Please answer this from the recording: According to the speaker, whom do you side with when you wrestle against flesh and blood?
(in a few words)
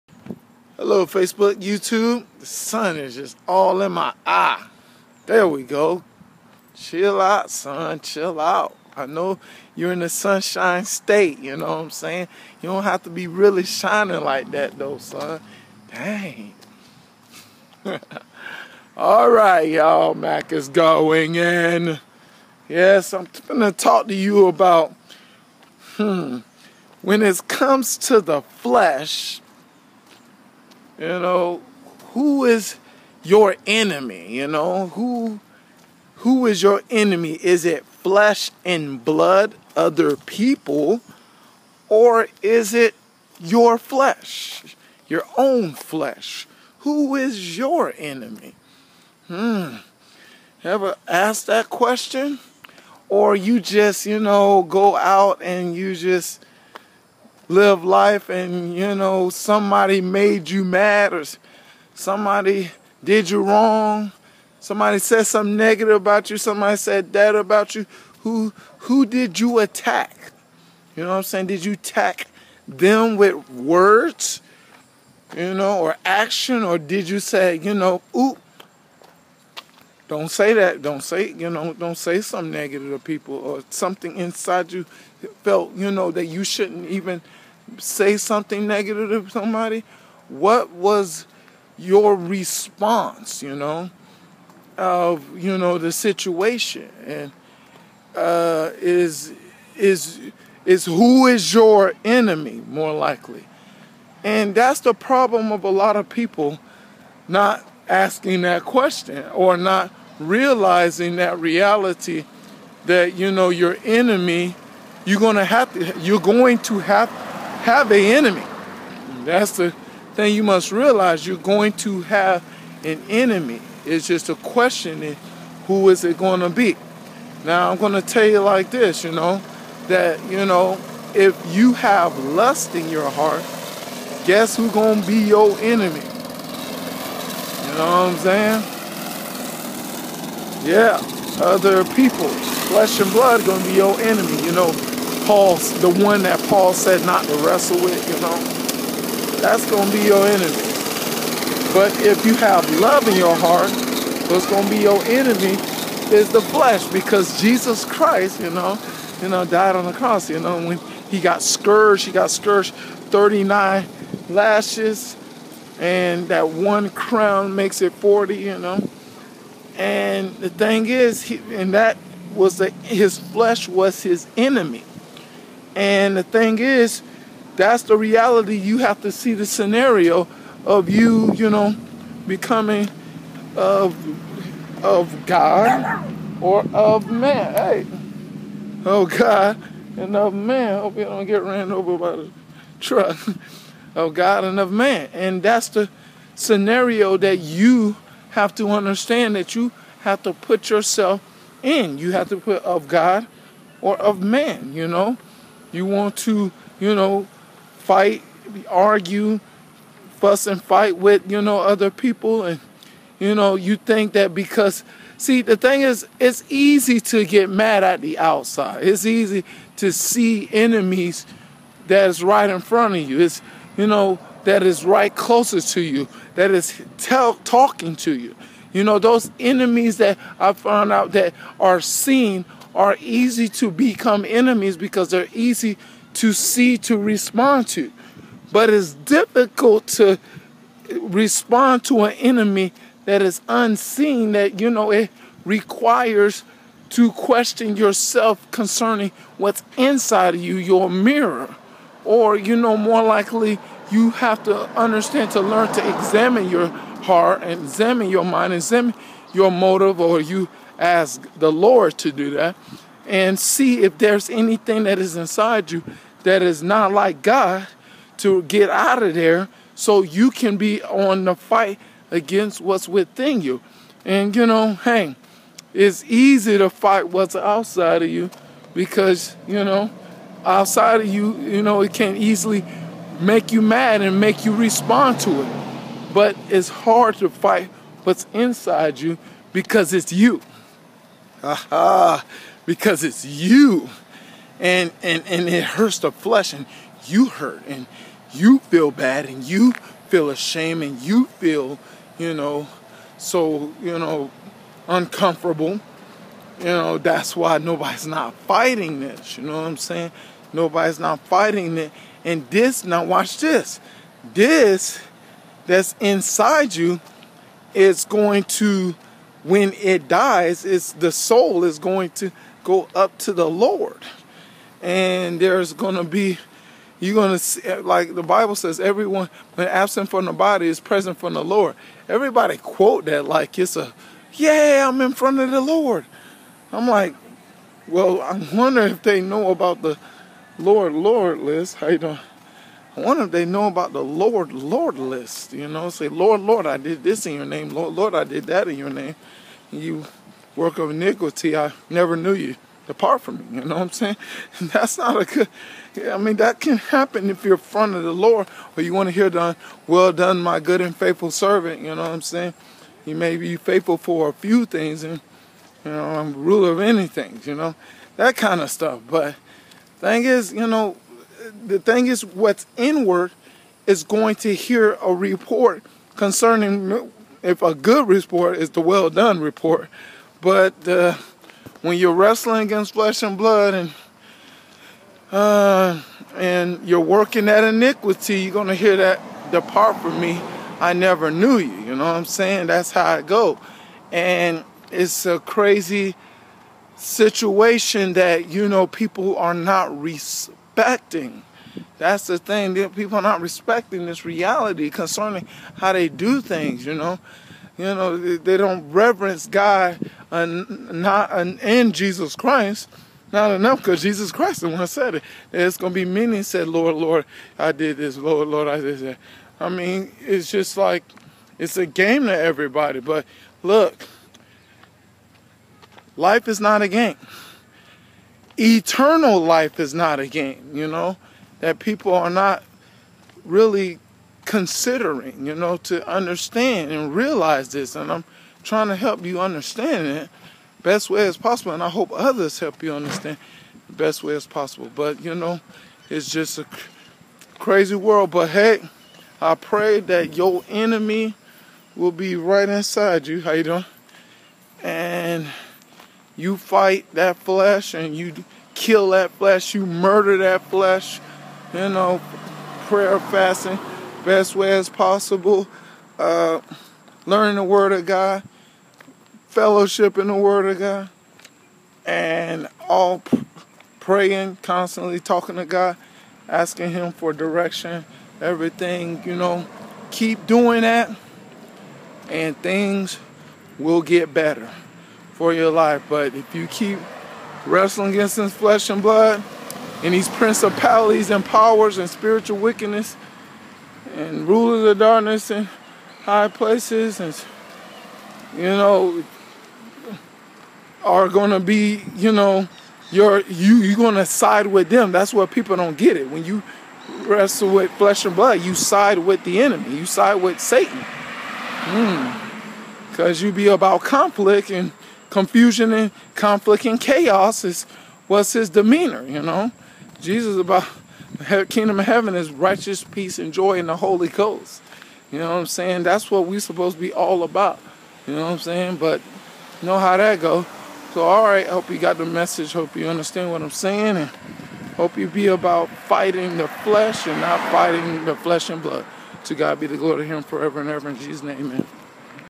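Satan.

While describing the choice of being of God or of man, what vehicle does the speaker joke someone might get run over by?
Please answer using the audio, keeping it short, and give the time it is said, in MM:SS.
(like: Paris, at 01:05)
truck, at 03:12.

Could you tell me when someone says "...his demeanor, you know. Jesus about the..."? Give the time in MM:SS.
08:38.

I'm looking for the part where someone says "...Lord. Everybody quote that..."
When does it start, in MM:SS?
05:31.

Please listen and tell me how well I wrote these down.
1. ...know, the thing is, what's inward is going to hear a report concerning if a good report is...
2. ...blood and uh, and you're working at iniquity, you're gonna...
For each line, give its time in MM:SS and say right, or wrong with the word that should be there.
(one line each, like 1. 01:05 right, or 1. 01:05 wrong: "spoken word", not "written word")
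1. 06:10 right
2. 06:23 right.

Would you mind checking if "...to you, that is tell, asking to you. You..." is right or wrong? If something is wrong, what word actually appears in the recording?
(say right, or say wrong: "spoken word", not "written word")
wrong: "talking", not "asking".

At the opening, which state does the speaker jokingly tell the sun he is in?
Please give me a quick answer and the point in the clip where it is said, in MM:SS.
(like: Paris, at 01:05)
Sunshine State, at 00:10.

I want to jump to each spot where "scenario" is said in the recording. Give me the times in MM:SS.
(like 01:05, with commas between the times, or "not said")
02:59, 03:16.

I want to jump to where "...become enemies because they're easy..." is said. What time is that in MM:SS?
03:53.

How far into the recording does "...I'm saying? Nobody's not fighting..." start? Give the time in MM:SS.
05:09.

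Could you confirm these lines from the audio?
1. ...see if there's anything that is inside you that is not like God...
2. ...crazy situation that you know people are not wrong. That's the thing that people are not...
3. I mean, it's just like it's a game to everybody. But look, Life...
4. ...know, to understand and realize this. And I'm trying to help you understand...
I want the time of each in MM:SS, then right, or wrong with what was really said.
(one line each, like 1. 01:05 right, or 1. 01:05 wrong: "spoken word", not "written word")
1. 04:23 right
2. 06:35 wrong: "respecting", not "wrong"
3. 06:59 right
4. 07:15 right.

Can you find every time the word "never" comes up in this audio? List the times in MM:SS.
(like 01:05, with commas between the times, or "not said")
05:51, 06:30.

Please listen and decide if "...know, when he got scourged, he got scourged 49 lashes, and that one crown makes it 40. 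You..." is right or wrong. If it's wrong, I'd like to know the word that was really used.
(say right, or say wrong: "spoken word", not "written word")
wrong: "39", not "49".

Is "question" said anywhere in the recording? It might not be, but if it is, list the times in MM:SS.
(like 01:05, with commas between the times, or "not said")
00:51, 01:48, 02:04, 04:07.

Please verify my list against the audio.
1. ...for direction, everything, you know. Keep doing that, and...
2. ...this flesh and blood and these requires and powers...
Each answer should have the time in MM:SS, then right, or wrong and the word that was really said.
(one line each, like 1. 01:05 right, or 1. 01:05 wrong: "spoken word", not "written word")
1. 07:57 right
2. 08:08 wrong: "principalities", not "requires".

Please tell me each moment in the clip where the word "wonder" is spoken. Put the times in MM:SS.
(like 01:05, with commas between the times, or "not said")
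05:38, 05:43.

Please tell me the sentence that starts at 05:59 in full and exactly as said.
Well done, my good and faithful servant.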